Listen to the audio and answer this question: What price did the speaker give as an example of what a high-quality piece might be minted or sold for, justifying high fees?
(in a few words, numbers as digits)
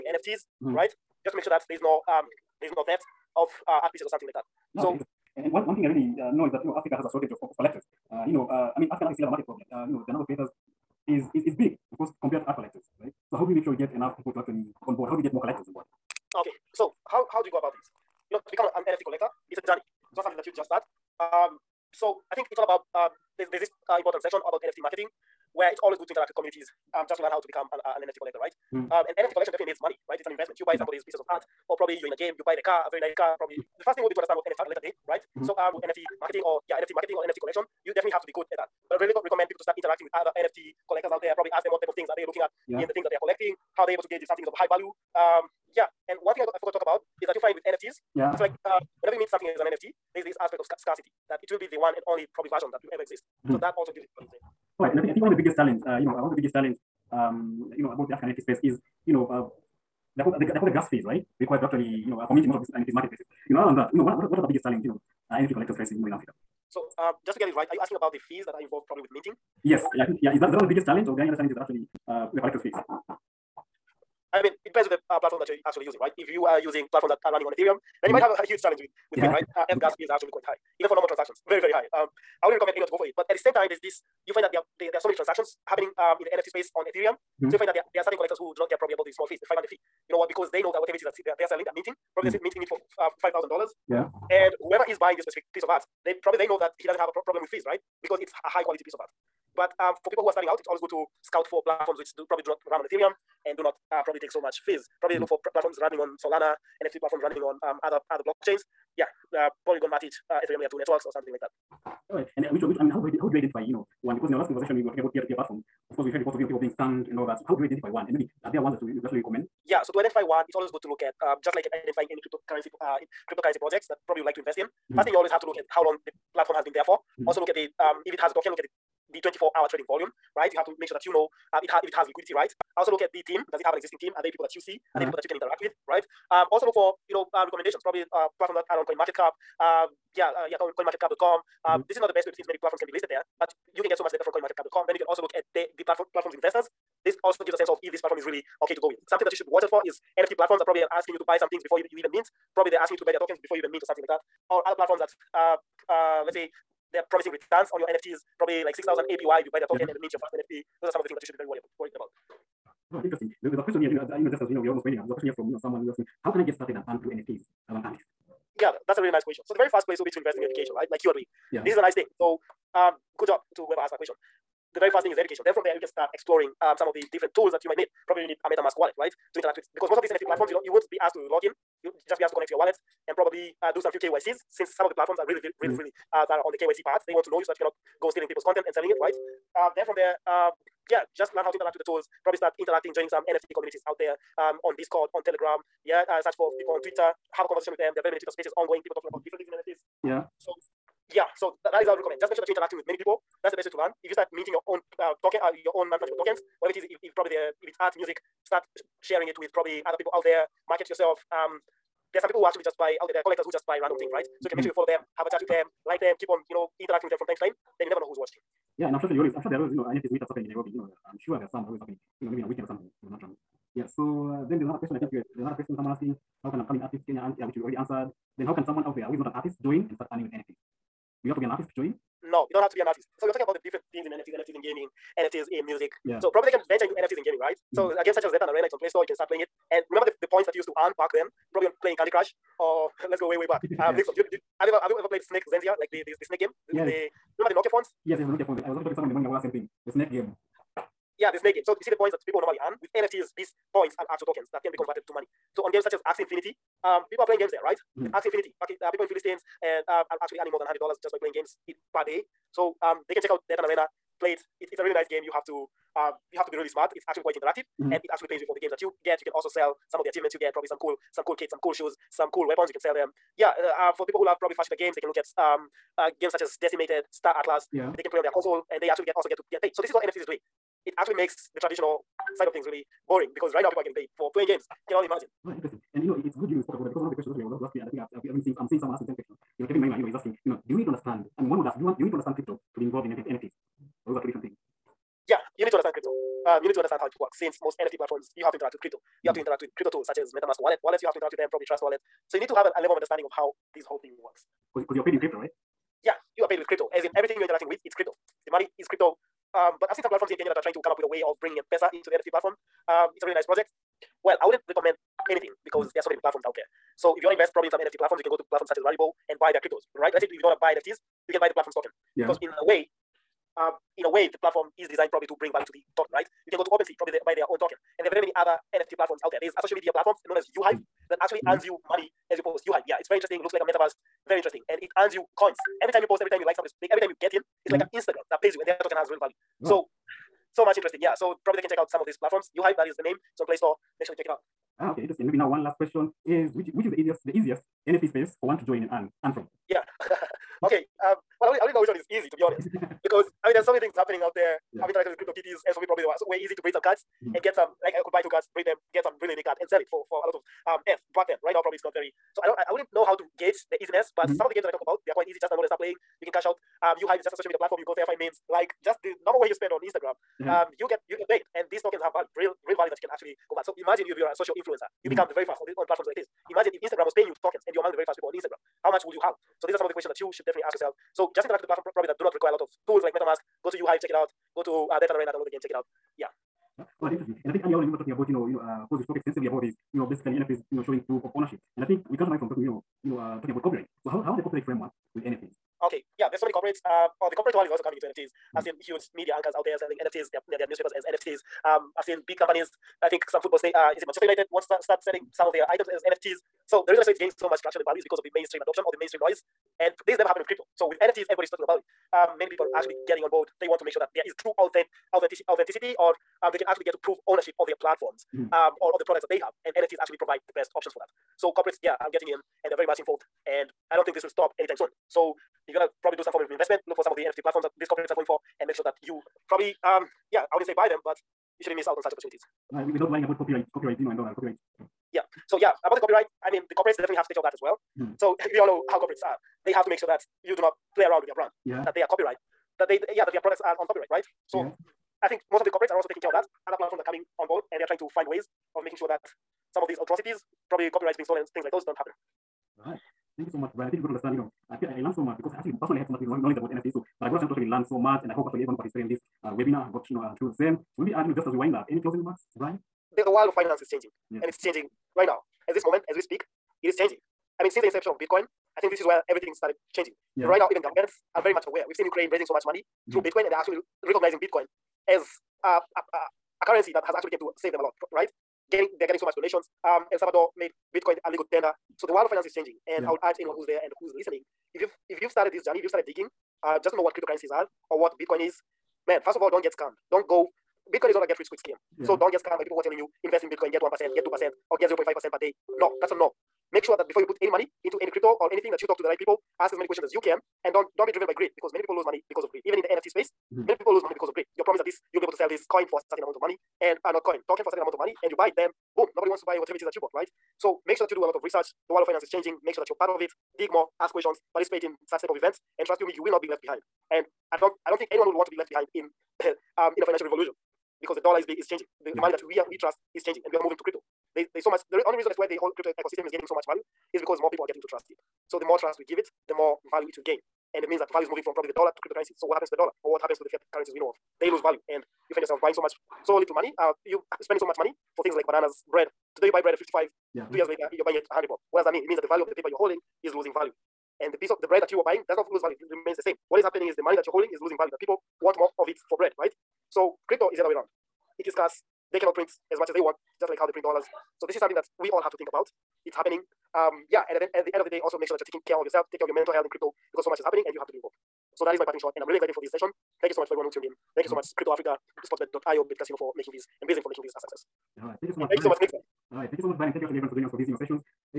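$5,000.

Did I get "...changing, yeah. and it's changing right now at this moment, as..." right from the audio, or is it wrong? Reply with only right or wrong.
right.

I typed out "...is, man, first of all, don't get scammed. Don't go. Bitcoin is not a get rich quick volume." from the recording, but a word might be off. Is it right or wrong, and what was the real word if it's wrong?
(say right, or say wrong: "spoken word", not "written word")
wrong: "scheme", not "volume".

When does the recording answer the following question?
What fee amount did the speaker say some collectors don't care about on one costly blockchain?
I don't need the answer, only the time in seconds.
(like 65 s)
89 s.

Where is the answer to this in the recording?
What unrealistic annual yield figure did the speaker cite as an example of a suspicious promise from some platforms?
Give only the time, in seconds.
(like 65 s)
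158 s.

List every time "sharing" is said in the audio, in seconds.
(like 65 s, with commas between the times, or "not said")
209 s.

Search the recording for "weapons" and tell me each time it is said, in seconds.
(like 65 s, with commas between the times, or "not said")
272 s.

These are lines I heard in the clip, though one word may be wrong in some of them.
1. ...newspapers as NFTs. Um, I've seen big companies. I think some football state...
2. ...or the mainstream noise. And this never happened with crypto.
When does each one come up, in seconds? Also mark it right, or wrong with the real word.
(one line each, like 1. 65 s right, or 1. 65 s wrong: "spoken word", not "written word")
1. 400 s right
2. 408 s right.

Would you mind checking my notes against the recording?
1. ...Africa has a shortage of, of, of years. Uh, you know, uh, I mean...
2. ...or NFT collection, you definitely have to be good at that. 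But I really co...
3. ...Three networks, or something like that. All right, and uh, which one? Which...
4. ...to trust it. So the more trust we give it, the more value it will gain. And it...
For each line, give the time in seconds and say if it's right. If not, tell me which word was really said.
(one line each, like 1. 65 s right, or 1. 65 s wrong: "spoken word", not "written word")
1. 6 s wrong: "collectors", not "years"
2. 37 s right
3. 110 s wrong: "Two", not "Three"
4. 527 s right.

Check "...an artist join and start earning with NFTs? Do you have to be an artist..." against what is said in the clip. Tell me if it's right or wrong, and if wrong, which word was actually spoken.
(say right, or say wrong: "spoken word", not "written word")
right.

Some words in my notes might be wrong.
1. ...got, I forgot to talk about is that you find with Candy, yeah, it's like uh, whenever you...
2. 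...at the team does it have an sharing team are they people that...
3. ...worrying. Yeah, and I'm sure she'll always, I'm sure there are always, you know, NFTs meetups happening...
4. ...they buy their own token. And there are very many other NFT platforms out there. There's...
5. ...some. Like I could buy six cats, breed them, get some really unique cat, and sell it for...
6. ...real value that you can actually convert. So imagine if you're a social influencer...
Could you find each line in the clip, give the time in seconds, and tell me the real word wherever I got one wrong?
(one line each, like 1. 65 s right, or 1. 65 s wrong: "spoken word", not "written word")
1. 46 s wrong: "NFTs", not "Candy"
2. 133 s wrong: "existing", not "sharing"
3. 218 s wrong: "watching", not "worrying"
4. 327 s right
5. 357 s wrong: "two", not "six"
6. 372 s right.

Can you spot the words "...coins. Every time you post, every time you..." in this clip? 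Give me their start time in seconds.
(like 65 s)
335 s.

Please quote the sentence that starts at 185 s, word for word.
really uh, that are on the KYC part.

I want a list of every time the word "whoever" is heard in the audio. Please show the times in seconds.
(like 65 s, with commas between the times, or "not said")
94 s, 173 s.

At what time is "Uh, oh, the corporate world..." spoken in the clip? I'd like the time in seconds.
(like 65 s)
396 s.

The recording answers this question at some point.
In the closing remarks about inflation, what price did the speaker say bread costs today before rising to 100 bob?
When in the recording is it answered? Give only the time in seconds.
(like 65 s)
539 s.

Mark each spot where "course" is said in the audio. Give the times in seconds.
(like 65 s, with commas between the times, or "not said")
11 s, 115 s, 388 s.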